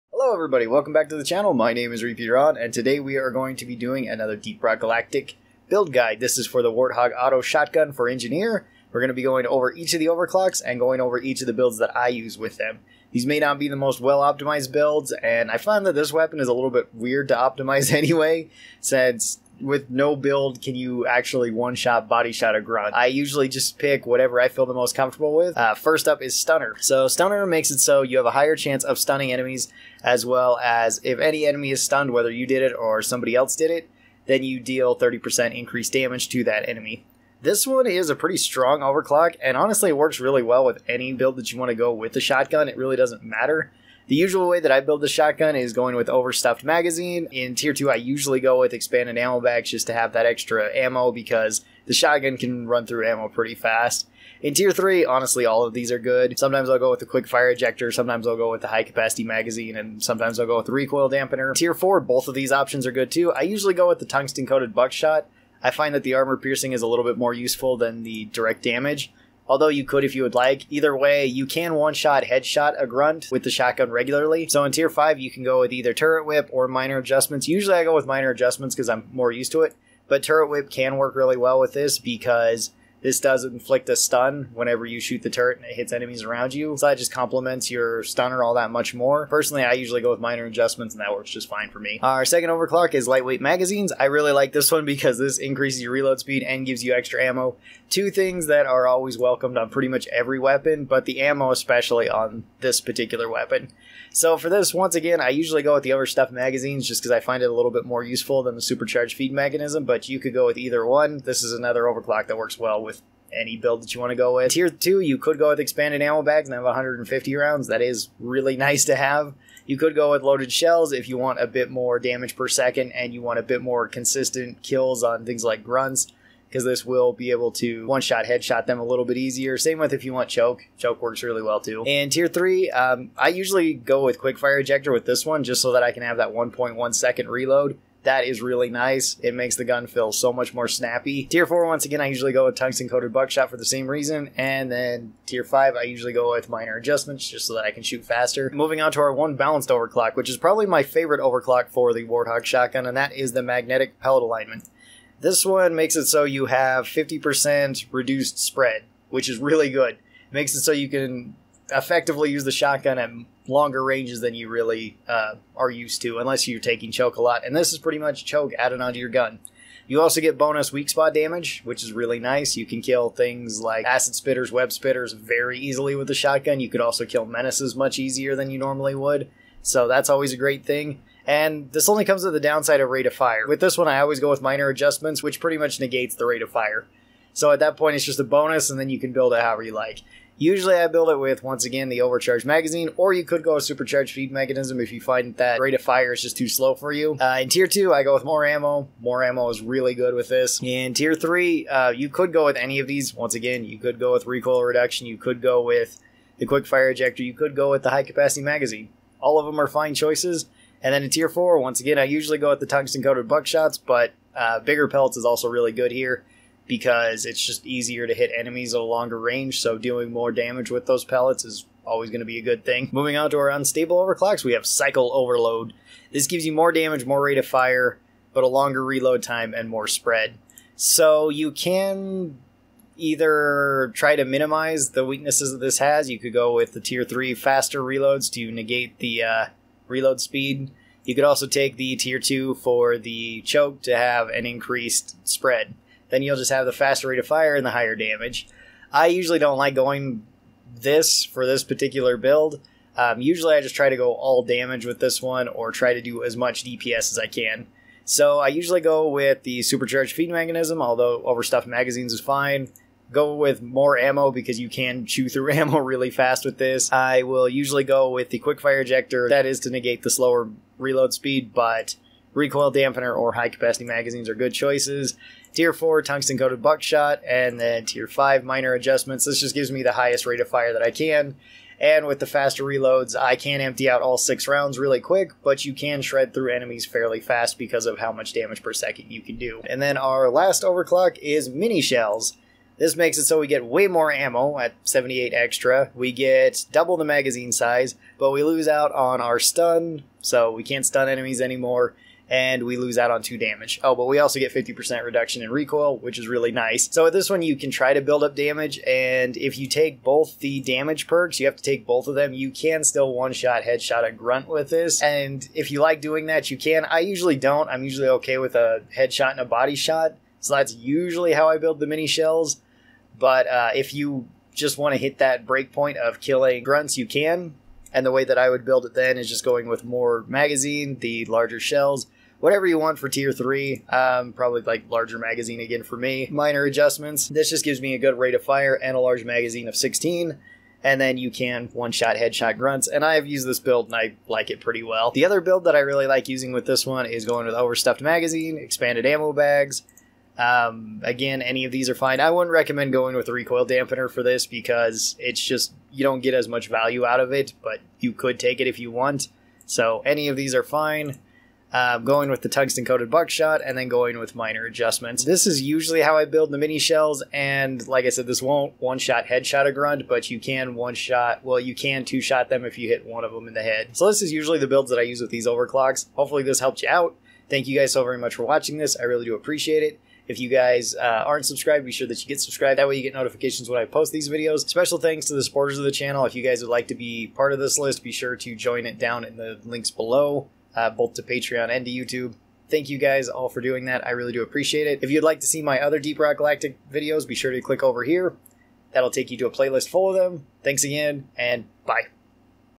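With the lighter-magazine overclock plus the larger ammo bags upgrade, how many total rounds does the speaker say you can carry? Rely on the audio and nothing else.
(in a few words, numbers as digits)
150.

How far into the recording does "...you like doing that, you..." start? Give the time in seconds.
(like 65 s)
315 s.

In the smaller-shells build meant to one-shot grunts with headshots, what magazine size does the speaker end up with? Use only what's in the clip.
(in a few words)
16.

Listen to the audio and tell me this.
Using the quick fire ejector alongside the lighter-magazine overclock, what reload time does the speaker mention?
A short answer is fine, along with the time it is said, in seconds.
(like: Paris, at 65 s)
1.1 seconds, at 136 s.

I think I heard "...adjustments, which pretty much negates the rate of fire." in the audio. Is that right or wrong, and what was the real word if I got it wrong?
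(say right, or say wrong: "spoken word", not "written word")
right.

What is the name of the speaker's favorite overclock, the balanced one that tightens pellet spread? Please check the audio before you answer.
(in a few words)
Magnetic Pellet Alignment.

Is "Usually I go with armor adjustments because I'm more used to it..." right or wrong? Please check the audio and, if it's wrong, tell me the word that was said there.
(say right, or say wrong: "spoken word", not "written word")
wrong: "minor", not "armor".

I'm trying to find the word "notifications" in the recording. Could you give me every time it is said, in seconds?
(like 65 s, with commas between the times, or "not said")
383 s.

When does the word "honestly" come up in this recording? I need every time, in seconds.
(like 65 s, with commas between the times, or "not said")
39 s, 55 s.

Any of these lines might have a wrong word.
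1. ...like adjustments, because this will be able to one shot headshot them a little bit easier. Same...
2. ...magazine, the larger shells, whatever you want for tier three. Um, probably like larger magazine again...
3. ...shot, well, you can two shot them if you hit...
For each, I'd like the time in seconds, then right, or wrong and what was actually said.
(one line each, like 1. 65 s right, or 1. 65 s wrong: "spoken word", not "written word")
1. 125 s wrong: "grunts", not "adjustments"
2. 330 s right
3. 370 s right.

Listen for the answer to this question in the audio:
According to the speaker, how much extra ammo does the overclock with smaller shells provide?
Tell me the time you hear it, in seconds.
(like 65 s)
294 s.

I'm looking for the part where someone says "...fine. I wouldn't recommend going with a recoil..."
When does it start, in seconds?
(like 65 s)
351 s.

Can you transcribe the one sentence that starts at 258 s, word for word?
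So I usually go with the supercharged feed mechanism, although overstuffed magazines is fine.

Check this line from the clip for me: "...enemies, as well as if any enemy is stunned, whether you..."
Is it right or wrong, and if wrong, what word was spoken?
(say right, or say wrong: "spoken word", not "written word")
right.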